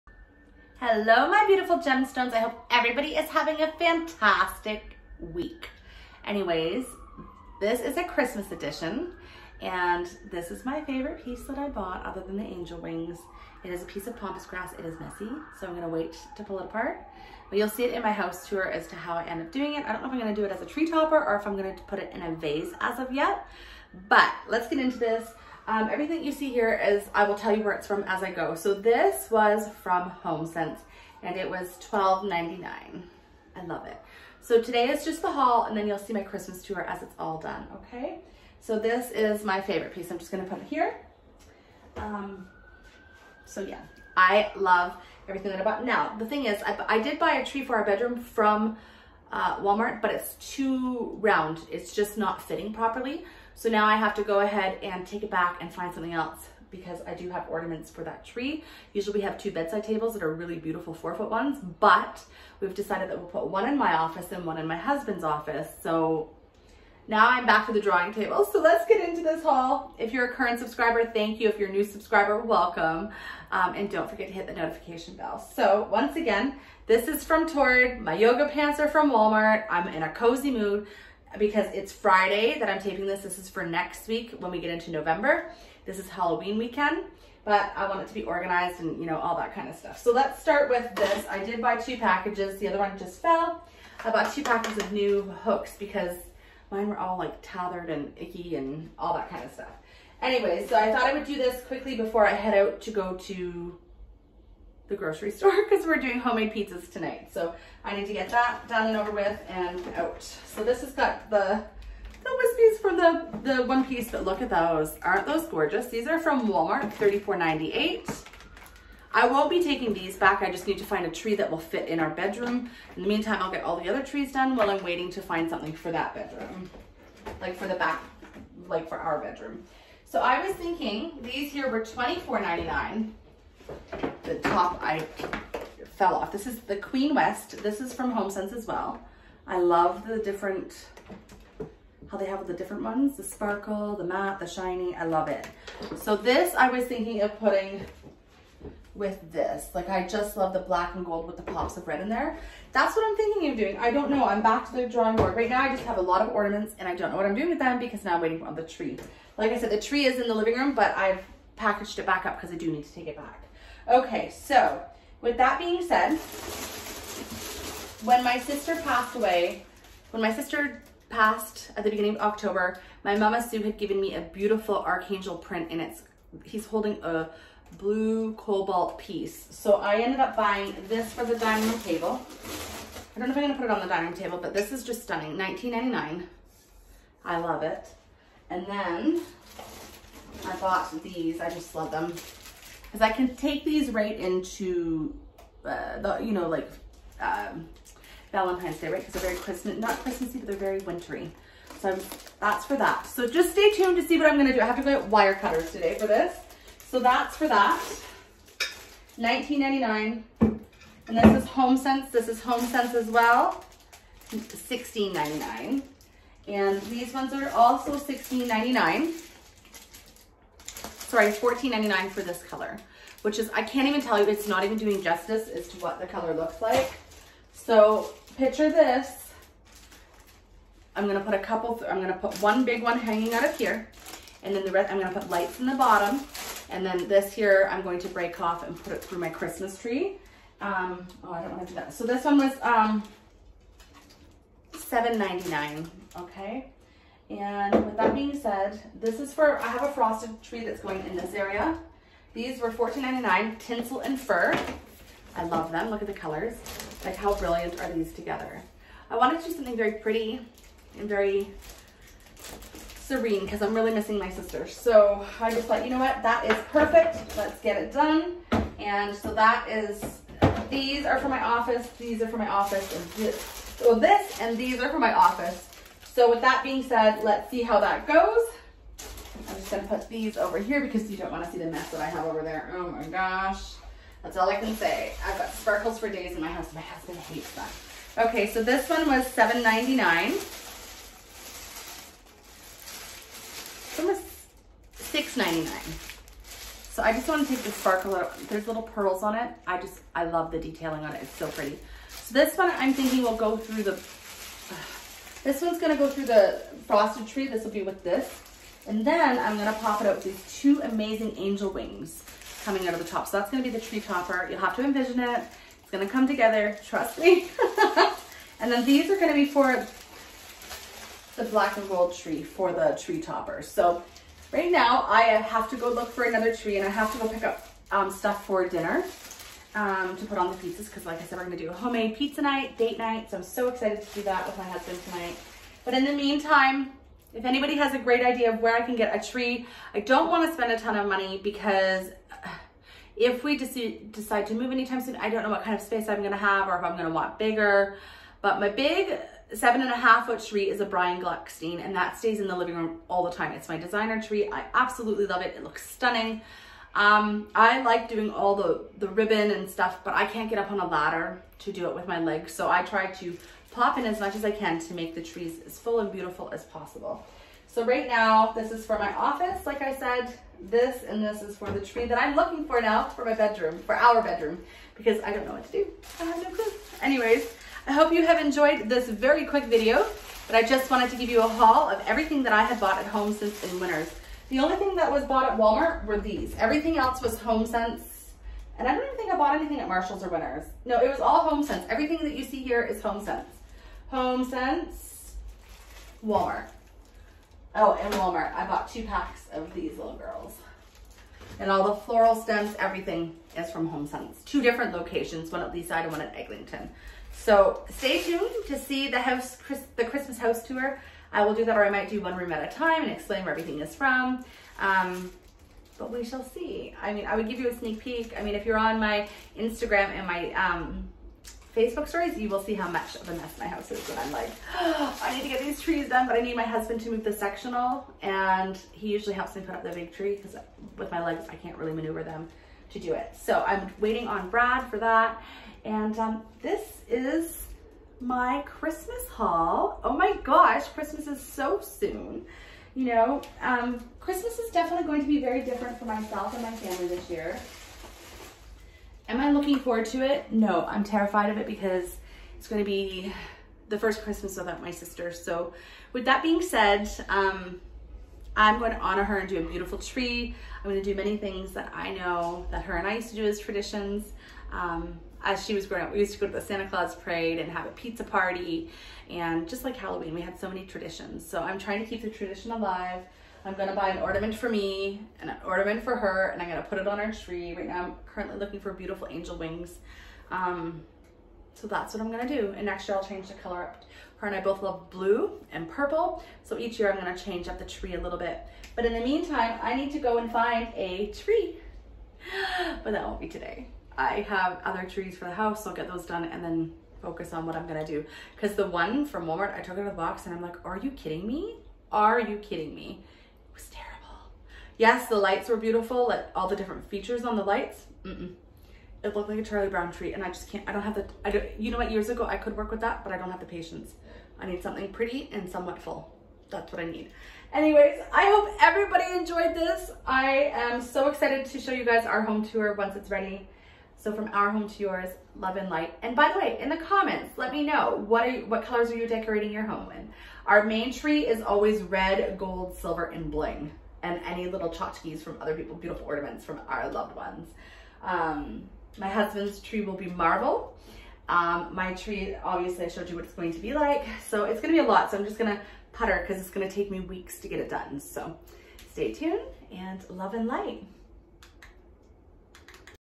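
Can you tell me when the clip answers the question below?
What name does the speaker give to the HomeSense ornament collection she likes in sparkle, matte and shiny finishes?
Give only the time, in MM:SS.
02:16.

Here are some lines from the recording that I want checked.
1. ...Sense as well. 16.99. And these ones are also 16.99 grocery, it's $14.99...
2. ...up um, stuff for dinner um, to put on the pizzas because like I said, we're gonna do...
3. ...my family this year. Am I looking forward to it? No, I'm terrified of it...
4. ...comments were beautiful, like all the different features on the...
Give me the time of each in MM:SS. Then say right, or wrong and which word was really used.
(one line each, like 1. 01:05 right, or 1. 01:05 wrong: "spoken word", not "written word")
1. 03:32 wrong: "sorry", not "grocery"
2. 05:27 right
3. 07:26 right
4. 08:25 wrong: "lights", not "comments".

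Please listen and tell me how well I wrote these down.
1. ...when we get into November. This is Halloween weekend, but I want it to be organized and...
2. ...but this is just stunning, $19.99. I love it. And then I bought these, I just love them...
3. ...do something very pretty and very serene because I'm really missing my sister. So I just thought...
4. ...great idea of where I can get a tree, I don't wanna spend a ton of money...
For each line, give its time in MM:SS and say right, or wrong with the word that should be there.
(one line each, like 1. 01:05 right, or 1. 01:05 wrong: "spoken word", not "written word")
1. 01:24 right
2. 03:04 right
3. 04:19 right
4. 05:37 right.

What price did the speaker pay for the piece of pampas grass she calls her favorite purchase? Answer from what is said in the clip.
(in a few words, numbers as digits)
$12.99.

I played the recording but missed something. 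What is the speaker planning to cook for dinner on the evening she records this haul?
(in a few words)
Homemade pizzas.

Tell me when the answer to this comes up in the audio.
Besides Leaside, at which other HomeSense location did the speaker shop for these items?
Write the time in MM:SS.
06:46.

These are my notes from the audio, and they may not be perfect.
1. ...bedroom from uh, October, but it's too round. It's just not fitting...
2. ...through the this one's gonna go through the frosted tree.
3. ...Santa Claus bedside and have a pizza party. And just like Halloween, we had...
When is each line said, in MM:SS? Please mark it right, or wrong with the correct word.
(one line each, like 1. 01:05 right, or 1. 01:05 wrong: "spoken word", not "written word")
1. 00:47 wrong: "Walmart", not "October"
2. 05:03 right
3. 07:46 wrong: "parade", not "bedside".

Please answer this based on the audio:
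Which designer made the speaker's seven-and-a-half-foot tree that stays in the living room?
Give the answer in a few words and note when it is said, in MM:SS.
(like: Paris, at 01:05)
Brian Gluckstein, at 05:50.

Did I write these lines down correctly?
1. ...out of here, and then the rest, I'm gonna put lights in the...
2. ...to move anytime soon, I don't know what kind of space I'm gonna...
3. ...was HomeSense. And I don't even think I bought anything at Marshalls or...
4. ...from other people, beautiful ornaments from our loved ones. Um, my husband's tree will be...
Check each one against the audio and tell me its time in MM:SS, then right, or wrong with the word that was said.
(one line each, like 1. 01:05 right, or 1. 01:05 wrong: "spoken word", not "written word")
1. 03:53 right
2. 05:44 right
3. 06:27 right
4. 08:55 right.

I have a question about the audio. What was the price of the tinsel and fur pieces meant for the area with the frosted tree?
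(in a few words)
$14.99.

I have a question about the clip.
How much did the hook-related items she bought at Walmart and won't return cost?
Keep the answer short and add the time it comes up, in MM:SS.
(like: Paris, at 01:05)
$34.98, at 01:56.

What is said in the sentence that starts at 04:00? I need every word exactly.
Um, oh, I don't wanna do that.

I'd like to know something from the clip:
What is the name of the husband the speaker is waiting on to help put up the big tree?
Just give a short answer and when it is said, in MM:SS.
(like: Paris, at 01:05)
Brad, at 07:14.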